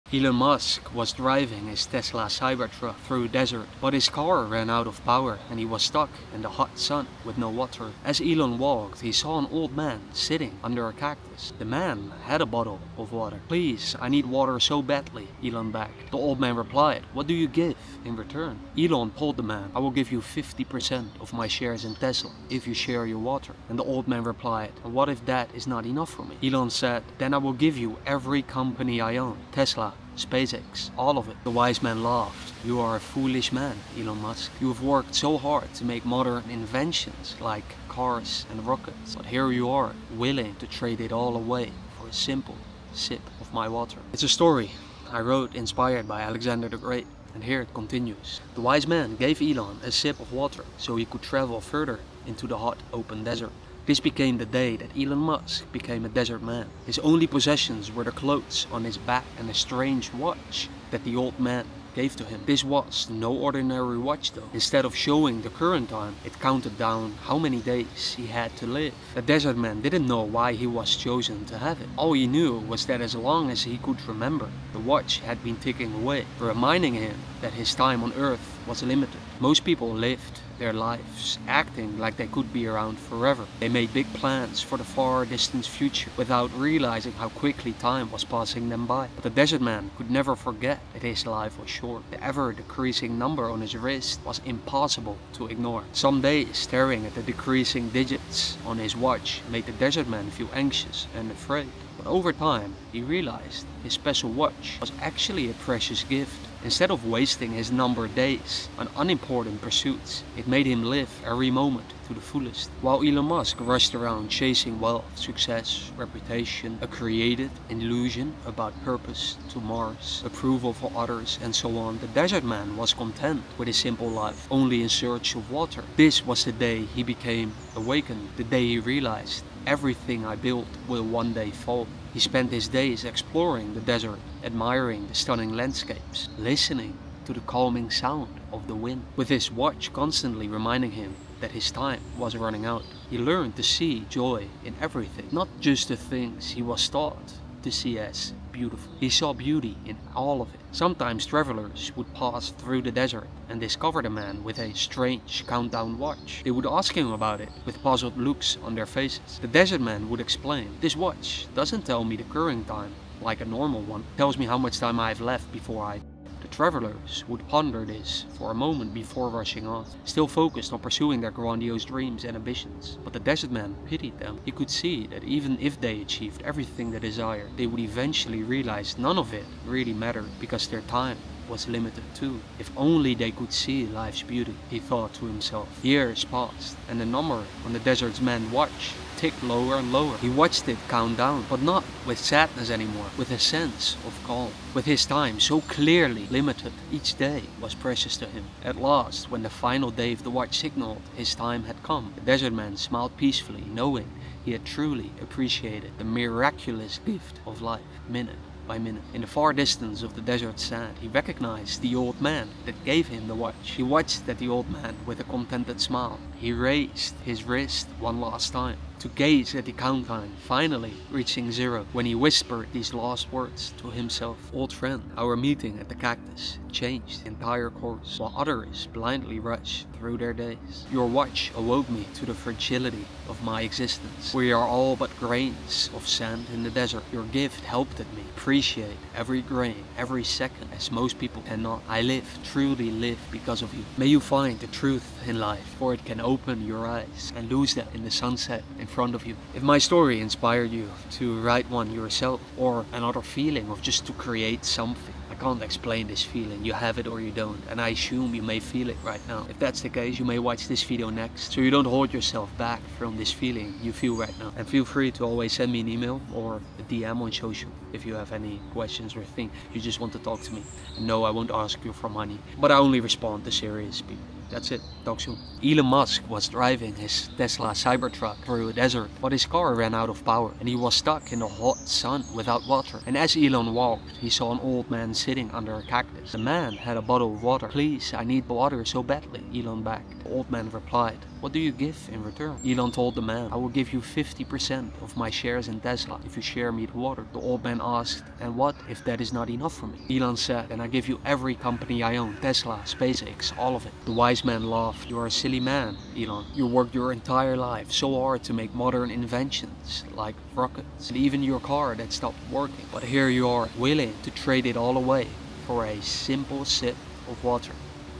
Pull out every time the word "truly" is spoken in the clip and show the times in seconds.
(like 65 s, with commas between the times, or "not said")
204 s, 242 s.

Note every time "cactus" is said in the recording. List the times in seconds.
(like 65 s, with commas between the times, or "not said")
10 s, 225 s, 285 s.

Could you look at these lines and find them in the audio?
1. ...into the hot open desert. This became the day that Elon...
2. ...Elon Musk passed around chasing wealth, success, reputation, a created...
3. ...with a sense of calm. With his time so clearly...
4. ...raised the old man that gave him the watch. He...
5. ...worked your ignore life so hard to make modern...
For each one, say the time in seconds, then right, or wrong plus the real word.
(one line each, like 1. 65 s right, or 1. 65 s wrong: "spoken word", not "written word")
1. 52 s right
2. 113 s wrong: "rushed", not "passed"
3. 193 s right
4. 211 s wrong: "recognized", not "raised"
5. 306 s wrong: "entire", not "ignore".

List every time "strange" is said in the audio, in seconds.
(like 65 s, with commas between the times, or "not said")
59 s, 154 s.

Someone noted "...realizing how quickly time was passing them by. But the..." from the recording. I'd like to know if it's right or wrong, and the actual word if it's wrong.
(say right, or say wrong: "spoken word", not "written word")
right.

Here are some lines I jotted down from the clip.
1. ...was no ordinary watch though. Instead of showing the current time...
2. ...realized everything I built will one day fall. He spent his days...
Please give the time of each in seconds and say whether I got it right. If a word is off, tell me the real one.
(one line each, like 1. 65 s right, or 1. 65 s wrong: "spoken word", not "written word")
1. 62 s right
2. 128 s right.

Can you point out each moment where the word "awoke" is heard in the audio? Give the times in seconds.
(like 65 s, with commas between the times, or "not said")
231 s.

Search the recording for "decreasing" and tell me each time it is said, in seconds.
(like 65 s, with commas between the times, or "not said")
92 s, 97 s.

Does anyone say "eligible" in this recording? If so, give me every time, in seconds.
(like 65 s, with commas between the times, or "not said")
not said.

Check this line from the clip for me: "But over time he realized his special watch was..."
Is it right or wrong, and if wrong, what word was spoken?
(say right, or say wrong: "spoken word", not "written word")
right.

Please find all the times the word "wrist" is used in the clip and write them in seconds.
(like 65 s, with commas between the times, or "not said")
93 s, 217 s.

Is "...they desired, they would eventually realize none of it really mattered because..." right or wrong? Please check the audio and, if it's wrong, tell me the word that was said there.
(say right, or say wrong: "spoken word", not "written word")
right.